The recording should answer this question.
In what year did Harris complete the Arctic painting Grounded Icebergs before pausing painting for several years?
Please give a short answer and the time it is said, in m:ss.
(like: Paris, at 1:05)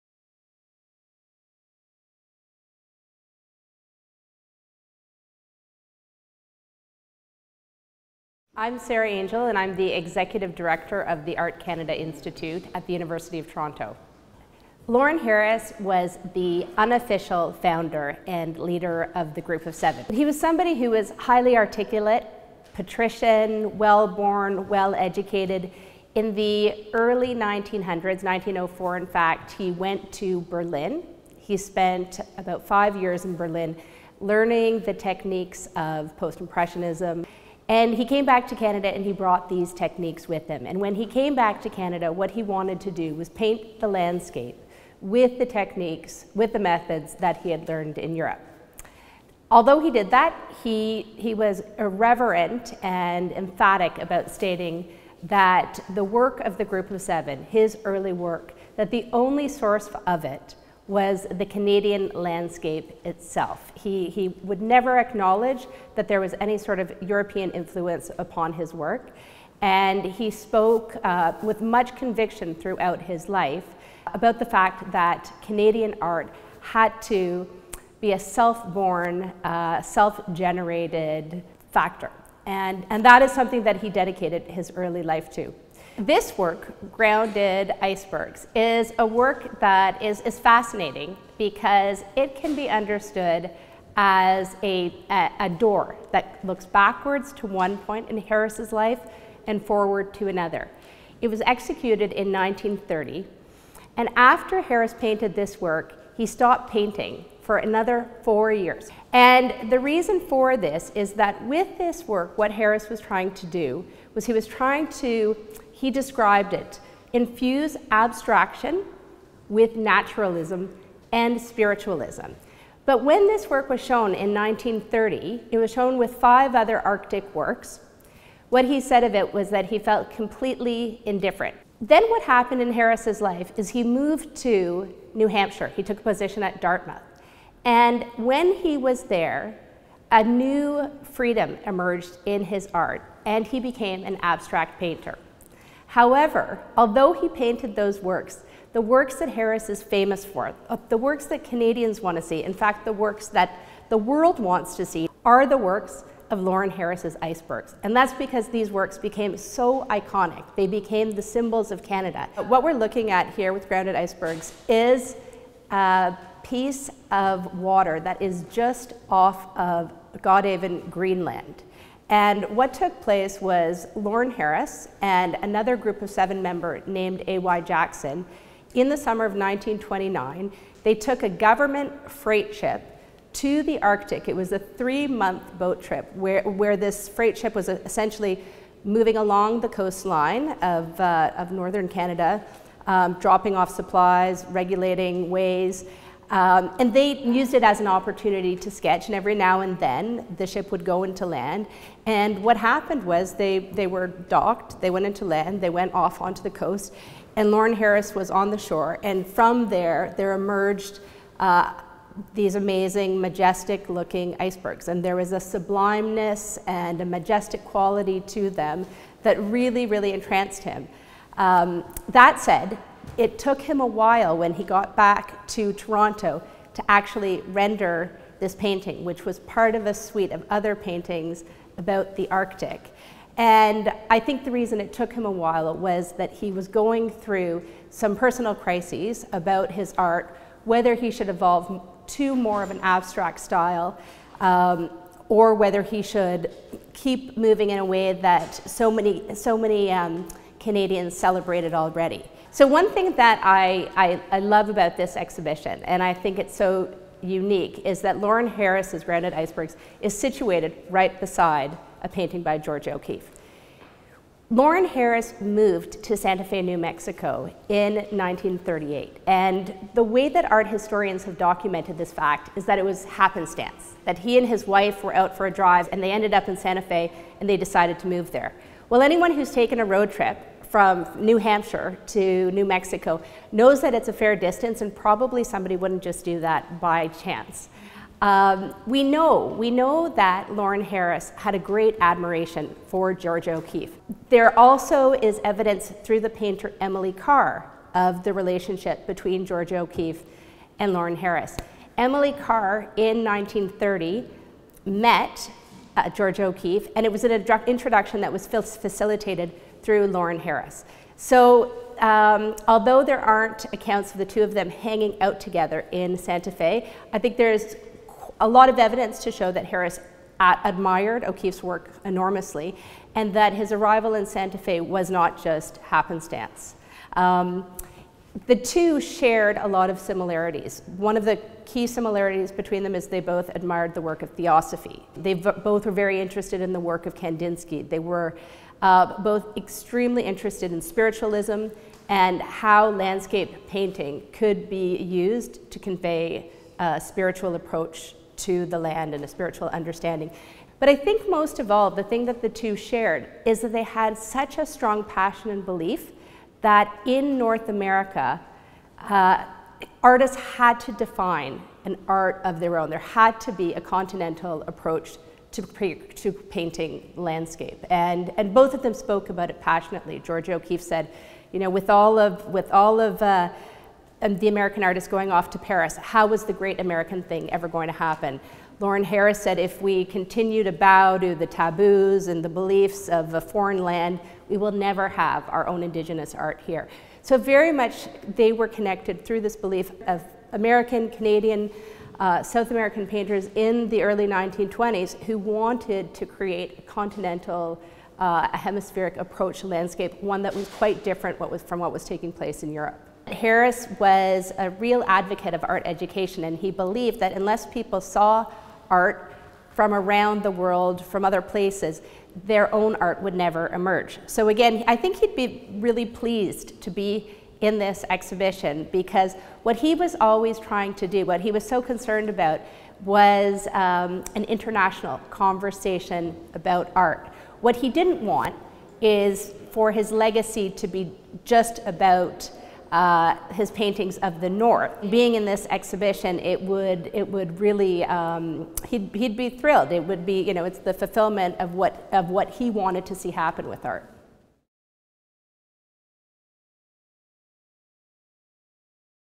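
1930, at 1:41.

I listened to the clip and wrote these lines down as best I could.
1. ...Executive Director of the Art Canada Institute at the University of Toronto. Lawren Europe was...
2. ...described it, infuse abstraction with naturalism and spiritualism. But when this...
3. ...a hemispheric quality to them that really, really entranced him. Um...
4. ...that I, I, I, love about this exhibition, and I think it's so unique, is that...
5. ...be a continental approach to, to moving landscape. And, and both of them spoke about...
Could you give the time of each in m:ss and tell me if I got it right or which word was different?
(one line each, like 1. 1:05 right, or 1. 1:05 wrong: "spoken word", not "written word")
1. 0:09 wrong: "Harris", not "Europe"
2. 1:55 right
3. 3:37 wrong: "majestic", not "hemispheric"
4. 4:13 right
5. 6:03 wrong: "painting", not "moving".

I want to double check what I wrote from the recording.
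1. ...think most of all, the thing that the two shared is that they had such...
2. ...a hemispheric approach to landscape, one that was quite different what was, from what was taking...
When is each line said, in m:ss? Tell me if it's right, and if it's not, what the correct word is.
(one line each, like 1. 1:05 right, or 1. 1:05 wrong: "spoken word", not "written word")
1. 5:50 right
2. 6:38 right.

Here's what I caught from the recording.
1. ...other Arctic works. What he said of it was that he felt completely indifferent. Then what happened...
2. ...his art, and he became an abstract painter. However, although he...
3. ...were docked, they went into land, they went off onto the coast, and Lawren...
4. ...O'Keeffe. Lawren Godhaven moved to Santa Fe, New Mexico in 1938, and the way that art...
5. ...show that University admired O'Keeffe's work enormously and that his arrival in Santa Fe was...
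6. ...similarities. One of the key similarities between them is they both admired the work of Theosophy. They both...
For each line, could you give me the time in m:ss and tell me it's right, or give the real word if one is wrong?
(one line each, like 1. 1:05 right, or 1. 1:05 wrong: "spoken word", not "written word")
1. 2:06 right
2. 2:22 right
3. 3:23 right
4. 4:22 wrong: "Harris", not "Godhaven"
5. 5:19 wrong: "Harris", not "University"
6. 5:29 right.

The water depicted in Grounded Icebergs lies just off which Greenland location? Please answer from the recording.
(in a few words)
Godhaven.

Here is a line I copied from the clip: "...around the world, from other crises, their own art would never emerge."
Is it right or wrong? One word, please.
wrong.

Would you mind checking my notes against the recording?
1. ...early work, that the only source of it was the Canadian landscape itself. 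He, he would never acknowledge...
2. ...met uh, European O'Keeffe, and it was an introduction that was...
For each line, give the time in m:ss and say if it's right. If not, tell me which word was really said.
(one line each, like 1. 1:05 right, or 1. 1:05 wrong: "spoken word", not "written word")
1. 0:57 right
2. 5:04 wrong: "Georgia", not "European".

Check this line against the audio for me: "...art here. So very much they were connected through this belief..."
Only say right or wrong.
right.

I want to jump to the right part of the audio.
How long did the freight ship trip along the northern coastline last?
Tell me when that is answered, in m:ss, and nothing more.
3:04.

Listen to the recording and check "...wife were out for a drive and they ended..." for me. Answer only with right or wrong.
right.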